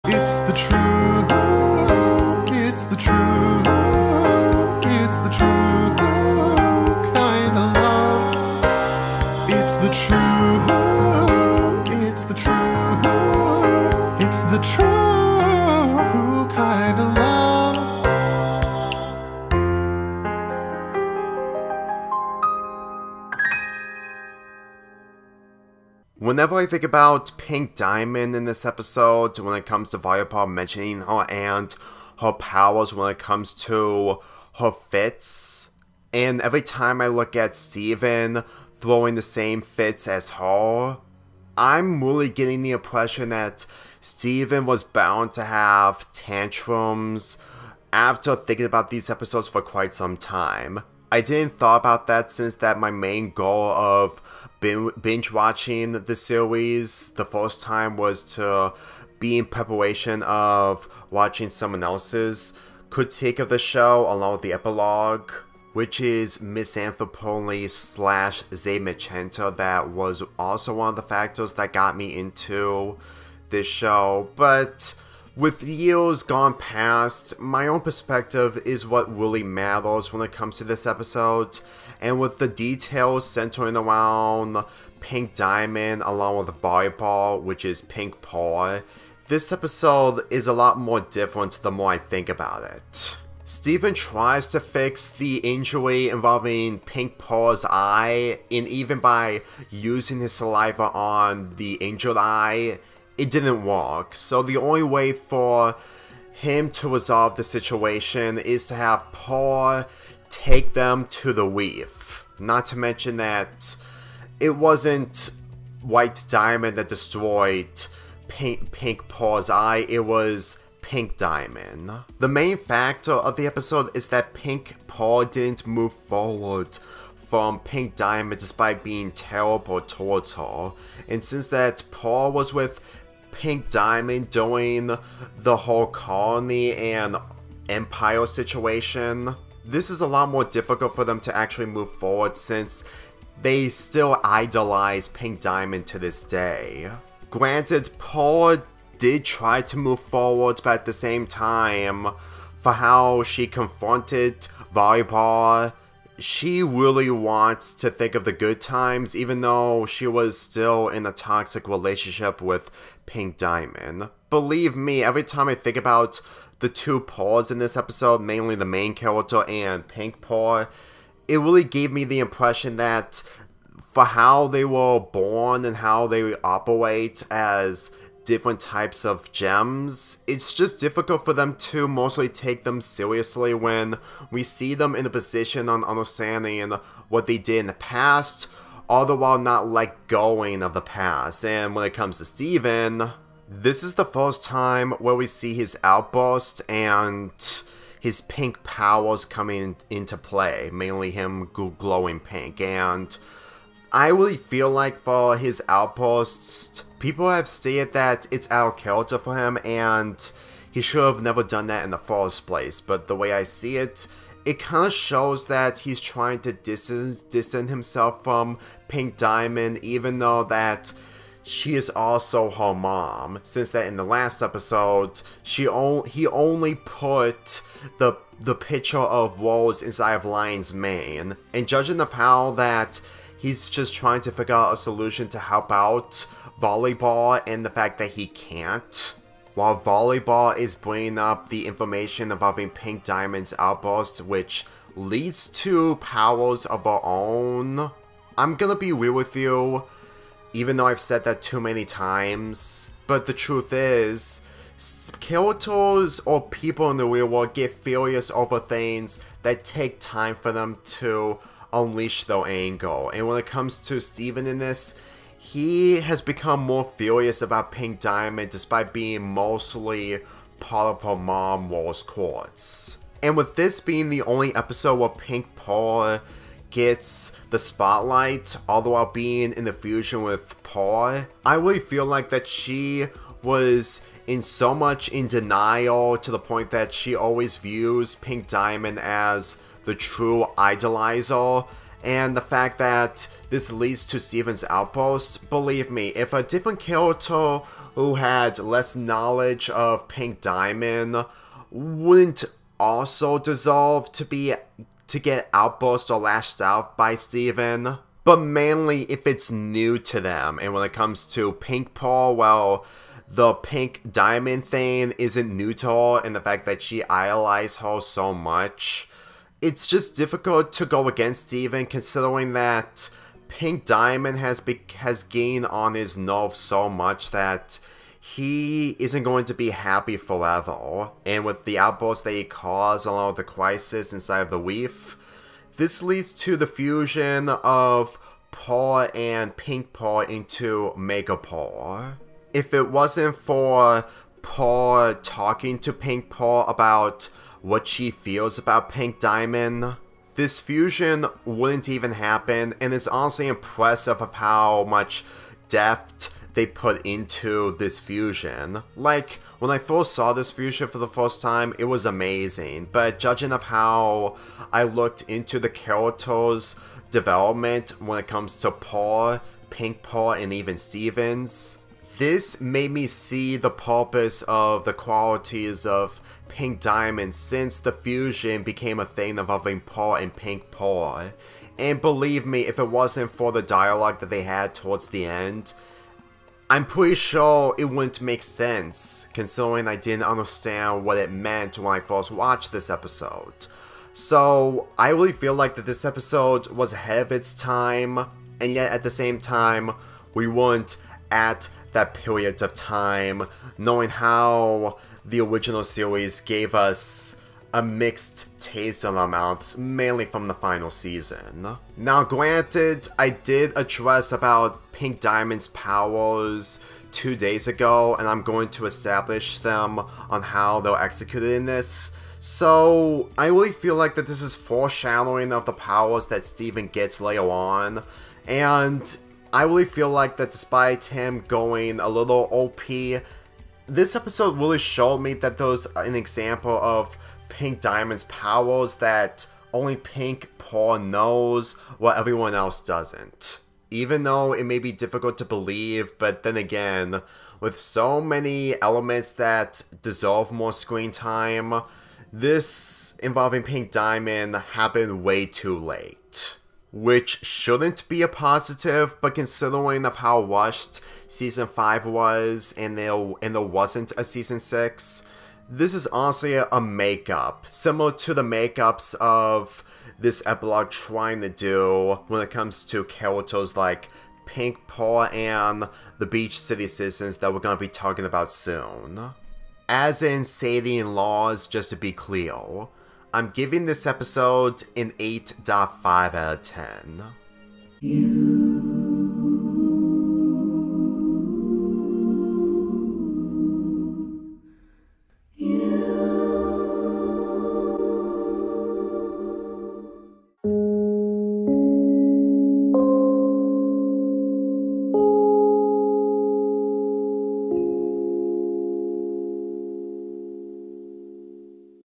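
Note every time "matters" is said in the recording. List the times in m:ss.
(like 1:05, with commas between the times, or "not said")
1:19.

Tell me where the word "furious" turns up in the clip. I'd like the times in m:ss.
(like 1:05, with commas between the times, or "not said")
4:17, 4:26.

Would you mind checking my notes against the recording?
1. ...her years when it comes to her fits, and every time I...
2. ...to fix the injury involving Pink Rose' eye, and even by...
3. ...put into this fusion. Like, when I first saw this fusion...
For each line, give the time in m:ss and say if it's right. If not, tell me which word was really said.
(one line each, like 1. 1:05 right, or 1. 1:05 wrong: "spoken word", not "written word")
1. 0:32 wrong: "powers", not "years"
2. 1:34 wrong: "Pearls", not "Rose"
3. 5:56 right.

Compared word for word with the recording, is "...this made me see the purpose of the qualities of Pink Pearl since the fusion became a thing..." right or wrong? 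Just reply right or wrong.
wrong.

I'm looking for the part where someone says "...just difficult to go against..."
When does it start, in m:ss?
5:19.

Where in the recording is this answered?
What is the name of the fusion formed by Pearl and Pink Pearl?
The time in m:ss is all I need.
5:40.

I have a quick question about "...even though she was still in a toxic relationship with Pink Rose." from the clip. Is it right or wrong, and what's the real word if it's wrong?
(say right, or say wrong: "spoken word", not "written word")
wrong: "Diamond", not "Rose".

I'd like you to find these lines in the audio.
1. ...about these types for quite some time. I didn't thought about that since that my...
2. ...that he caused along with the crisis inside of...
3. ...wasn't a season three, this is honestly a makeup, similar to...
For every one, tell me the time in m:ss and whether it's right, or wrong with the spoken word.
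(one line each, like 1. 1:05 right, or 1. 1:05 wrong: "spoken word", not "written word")
1. 0:48 wrong: "episodes", not "types"
2. 5:32 right
3. 7:43 wrong: "six", not "three".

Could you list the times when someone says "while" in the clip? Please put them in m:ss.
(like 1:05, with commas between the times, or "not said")
3:09, 3:59, 4:38, 7:21.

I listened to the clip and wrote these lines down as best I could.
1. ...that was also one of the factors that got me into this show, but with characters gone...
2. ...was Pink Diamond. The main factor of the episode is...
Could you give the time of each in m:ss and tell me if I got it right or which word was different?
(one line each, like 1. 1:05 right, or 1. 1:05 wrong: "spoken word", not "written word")
1. 1:09 wrong: "years", not "characters"
2. 2:00 right.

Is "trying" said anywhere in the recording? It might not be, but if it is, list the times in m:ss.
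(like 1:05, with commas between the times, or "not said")
3:35, 3:53, 7:50.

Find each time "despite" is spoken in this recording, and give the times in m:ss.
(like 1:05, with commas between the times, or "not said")
2:08, 4:28, 7:10.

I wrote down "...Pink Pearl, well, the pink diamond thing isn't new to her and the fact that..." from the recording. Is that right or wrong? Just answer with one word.
right.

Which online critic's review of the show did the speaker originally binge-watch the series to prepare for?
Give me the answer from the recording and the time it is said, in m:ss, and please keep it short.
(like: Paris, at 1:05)
Misanthropoli, at 1:06.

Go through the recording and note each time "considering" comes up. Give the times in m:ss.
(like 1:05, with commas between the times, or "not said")
5:21, 6:29, 7:39.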